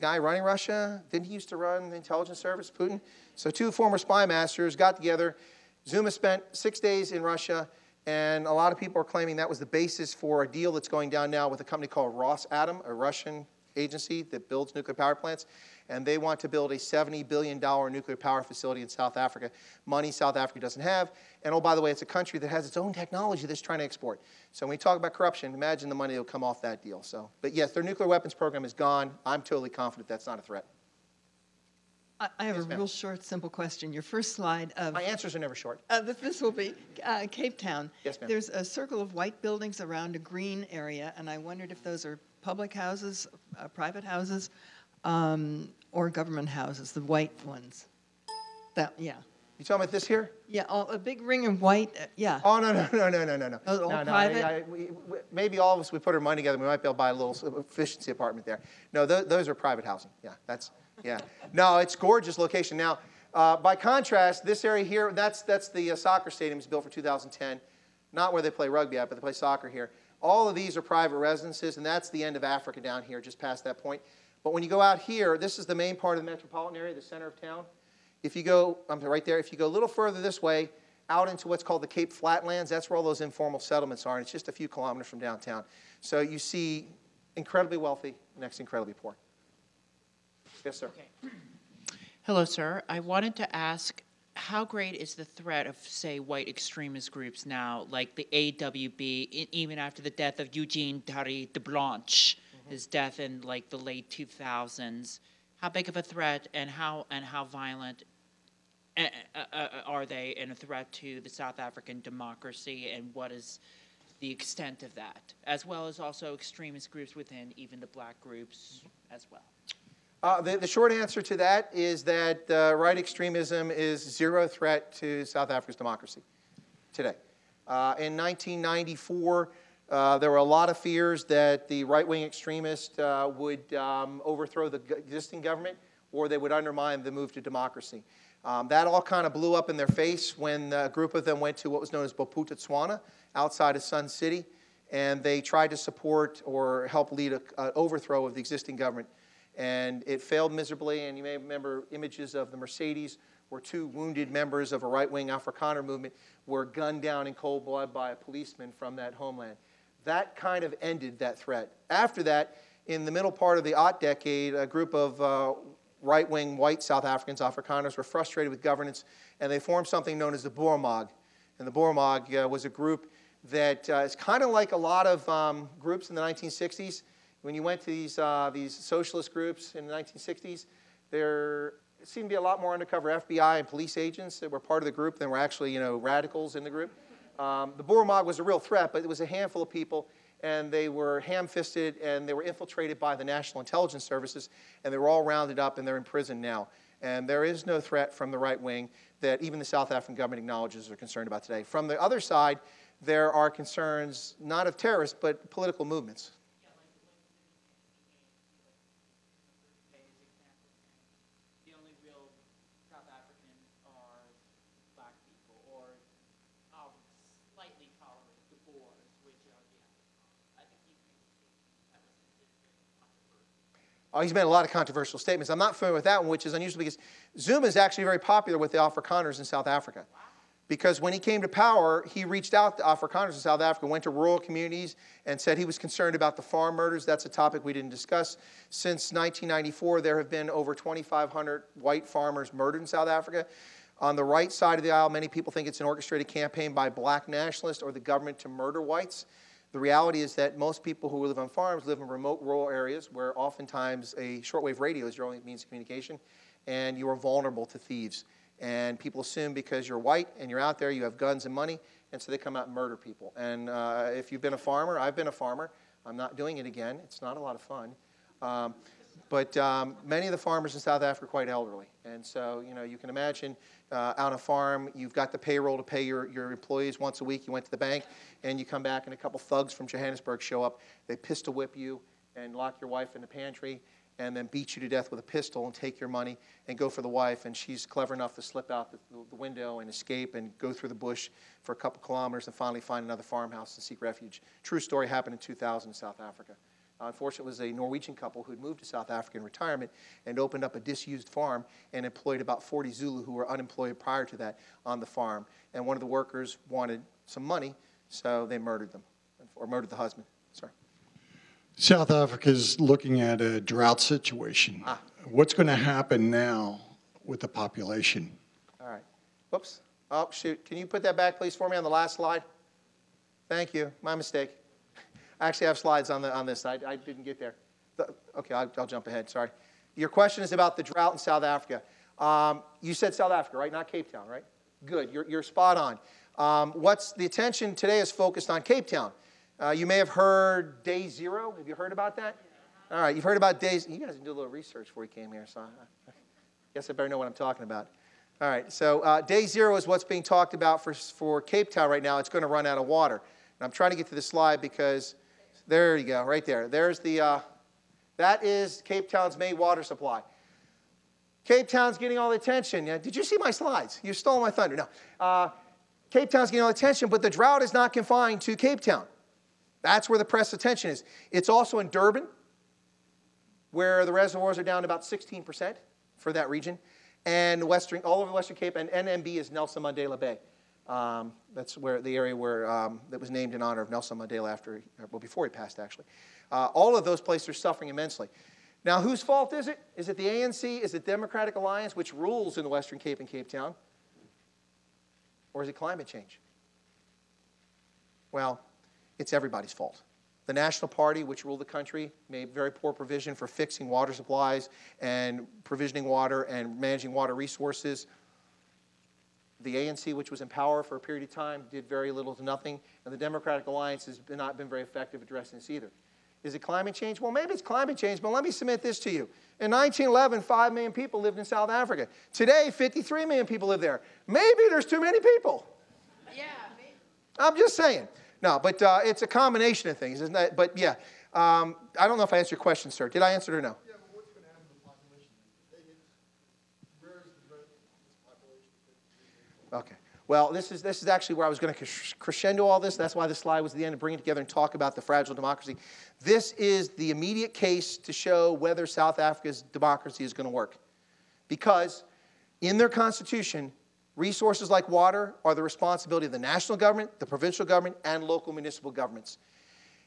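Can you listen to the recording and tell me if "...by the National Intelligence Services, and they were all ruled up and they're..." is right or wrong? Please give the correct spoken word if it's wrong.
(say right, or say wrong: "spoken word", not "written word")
wrong: "rounded", not "ruled".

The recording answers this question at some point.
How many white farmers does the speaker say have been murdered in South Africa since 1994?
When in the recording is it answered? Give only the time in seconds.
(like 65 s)
240 s.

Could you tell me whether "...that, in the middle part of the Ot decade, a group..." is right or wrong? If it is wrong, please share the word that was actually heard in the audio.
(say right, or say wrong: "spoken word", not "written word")
right.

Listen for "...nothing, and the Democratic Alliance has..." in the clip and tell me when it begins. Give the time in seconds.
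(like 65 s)
412 s.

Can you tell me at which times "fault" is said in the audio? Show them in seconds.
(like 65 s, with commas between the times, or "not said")
389 s, 399 s.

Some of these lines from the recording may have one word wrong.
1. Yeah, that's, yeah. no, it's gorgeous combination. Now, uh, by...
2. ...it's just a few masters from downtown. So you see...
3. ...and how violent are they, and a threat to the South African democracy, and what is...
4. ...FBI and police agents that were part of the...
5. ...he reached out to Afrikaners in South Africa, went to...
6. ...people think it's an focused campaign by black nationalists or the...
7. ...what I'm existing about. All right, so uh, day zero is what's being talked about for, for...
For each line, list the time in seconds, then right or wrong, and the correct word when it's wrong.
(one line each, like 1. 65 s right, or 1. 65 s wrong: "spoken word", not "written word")
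1. 60 s wrong: "location", not "combination"
2. 84 s wrong: "kilometers", not "masters"
3. 107 s right
4. 183 s right
5. 232 s right
6. 245 s wrong: "orchestrated", not "focused"
7. 347 s wrong: "talking", not "existing".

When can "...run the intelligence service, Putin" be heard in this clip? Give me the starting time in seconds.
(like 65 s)
1 s.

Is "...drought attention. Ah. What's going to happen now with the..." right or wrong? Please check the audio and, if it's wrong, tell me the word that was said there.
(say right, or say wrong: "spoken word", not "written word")
wrong: "situation", not "attention".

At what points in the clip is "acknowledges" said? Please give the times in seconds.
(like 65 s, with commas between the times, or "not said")
200 s.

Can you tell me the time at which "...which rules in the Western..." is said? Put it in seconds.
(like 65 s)
391 s.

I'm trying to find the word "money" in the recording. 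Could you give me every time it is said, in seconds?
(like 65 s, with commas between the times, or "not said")
19 s, 25 s, 56 s, 261 s, 286 s, 307 s.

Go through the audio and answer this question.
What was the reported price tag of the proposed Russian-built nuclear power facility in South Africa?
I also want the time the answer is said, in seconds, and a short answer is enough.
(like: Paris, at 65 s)
$70 billion, at 16 s.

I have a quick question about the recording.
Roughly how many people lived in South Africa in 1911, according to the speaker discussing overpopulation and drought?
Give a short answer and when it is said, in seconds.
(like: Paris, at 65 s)
5 million, at 420 s.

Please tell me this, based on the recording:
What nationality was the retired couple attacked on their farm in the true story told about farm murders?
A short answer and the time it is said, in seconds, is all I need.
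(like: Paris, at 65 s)
Norwegian, at 297 s.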